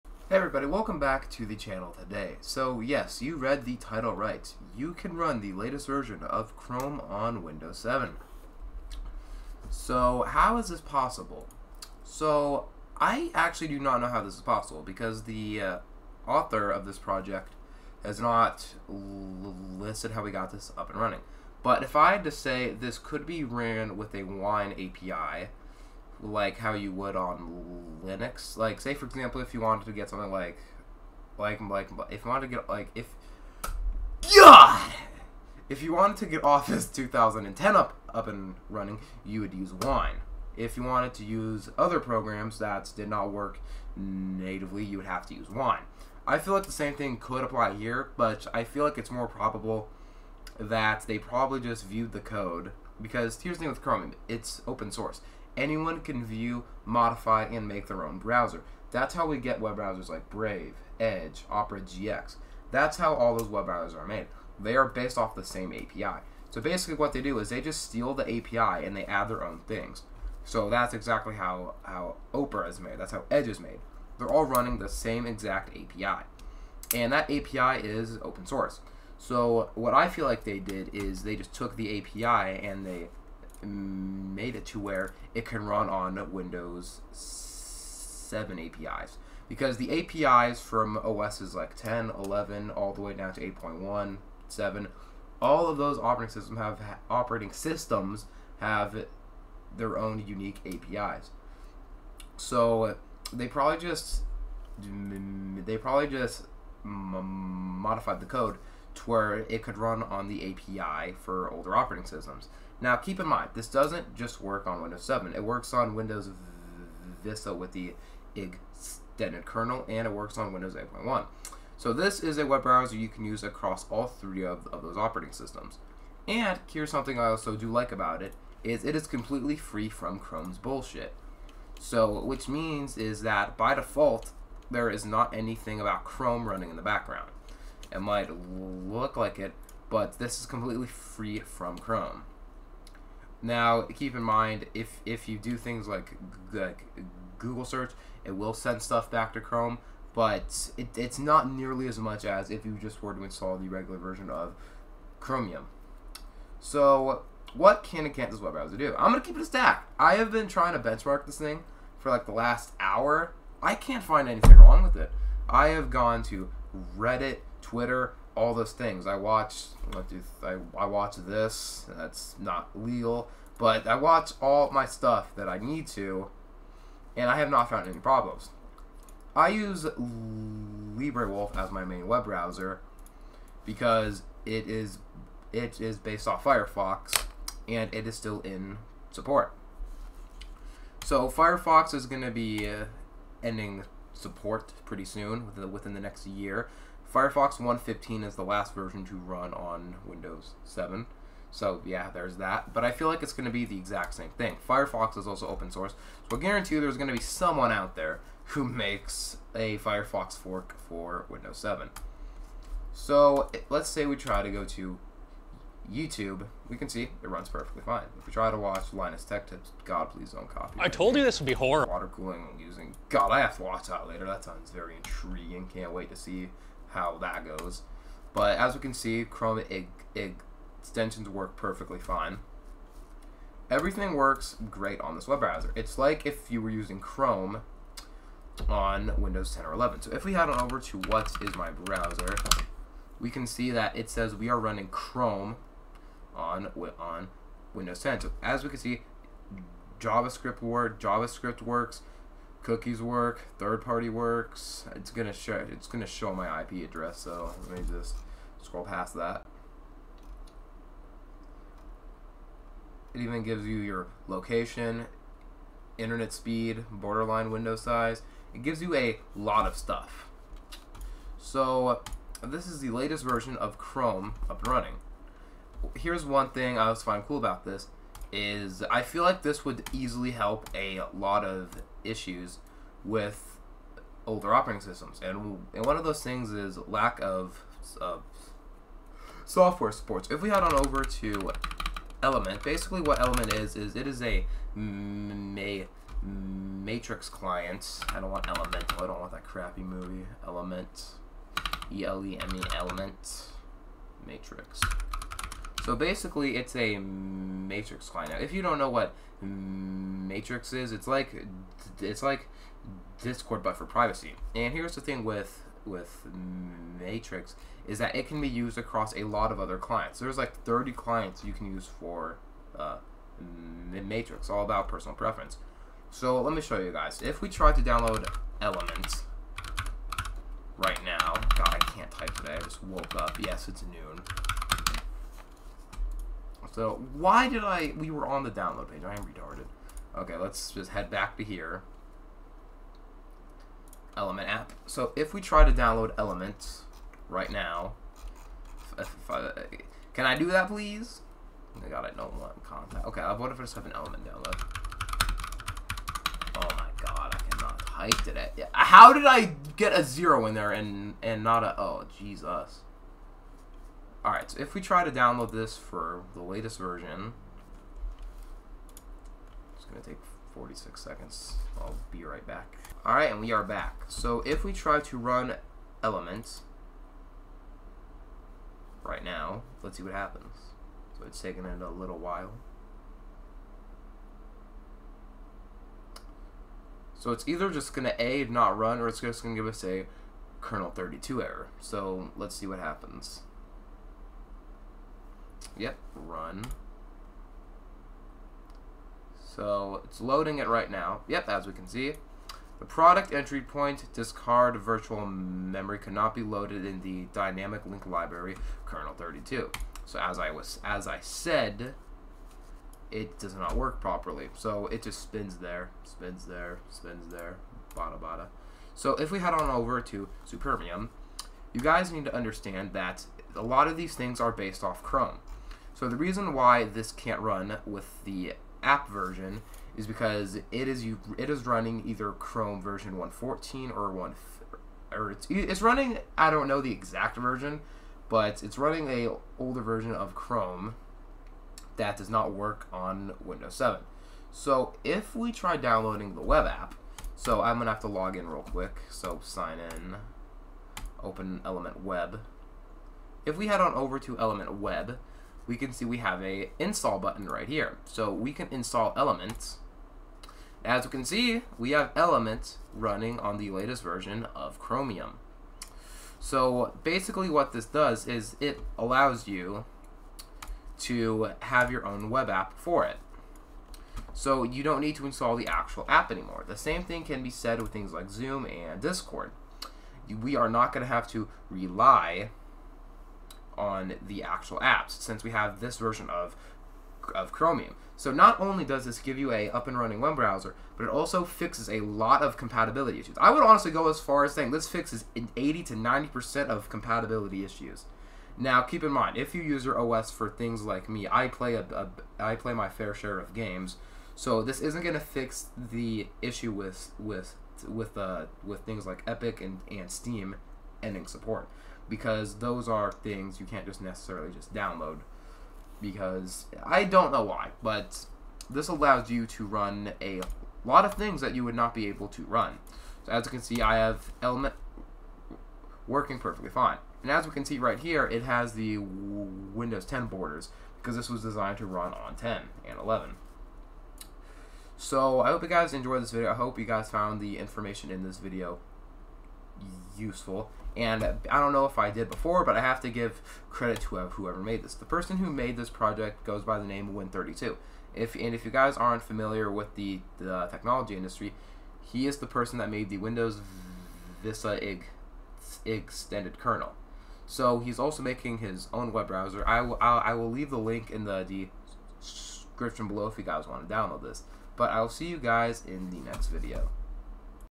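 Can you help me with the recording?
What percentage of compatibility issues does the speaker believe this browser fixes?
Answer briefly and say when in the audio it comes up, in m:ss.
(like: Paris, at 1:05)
80 to 90%, at 8:15.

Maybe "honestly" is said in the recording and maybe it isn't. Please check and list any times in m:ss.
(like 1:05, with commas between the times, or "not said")
8:13.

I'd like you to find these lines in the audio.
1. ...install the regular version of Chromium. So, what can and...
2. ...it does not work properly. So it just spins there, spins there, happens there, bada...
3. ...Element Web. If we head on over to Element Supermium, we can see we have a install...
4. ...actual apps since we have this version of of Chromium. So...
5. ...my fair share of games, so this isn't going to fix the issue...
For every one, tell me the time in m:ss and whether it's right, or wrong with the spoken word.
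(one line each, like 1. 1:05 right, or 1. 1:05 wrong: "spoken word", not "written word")
1. 2:33 right
2. 6:53 wrong: "spins", not "happens"
3. 7:31 wrong: "Web", not "Supermium"
4. 8:04 right
5. 8:22 right.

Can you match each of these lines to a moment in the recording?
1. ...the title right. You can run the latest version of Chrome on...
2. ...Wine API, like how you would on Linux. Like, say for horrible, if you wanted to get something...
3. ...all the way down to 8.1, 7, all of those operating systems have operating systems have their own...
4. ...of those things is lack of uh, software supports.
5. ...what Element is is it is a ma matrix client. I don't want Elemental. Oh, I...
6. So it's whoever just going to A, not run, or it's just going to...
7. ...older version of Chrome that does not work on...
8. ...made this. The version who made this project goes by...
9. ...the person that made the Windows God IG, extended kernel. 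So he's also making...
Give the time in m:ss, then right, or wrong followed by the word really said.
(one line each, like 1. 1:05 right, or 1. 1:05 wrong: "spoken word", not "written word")
1. 0:03 right
2. 0:24 wrong: "example", not "horrible"
3. 1:32 right
4. 4:45 right
5. 4:53 right
6. 6:27 wrong: "either", not "whoever"
7. 7:19 right
8. 9:04 wrong: "person", not "version"
9. 9:12 wrong: "Vista", not "God".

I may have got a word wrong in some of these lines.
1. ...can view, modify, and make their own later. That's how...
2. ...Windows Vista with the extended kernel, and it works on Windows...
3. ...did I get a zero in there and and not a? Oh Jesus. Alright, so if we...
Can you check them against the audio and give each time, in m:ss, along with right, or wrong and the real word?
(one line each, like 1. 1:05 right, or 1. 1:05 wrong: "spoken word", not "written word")
1. 0:56 wrong: "browser", not "later"
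2. 1:55 right
3. 5:59 right.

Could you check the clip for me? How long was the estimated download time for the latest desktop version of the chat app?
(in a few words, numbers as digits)
46 seconds.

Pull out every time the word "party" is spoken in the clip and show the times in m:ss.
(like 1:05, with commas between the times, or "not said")
4:13.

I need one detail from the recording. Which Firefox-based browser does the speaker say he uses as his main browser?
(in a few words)
LibreWolf.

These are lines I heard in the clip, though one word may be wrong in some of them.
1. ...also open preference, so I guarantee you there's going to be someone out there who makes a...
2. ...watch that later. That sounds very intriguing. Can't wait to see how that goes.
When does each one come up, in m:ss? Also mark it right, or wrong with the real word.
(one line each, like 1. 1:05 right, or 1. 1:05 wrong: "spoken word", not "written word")
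1. 3:25 wrong: "source", not "preference"
2. 3:43 right.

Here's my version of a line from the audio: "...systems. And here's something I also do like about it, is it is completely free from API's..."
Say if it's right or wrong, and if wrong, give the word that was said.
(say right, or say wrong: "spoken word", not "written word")
wrong: "Chrome", not "API".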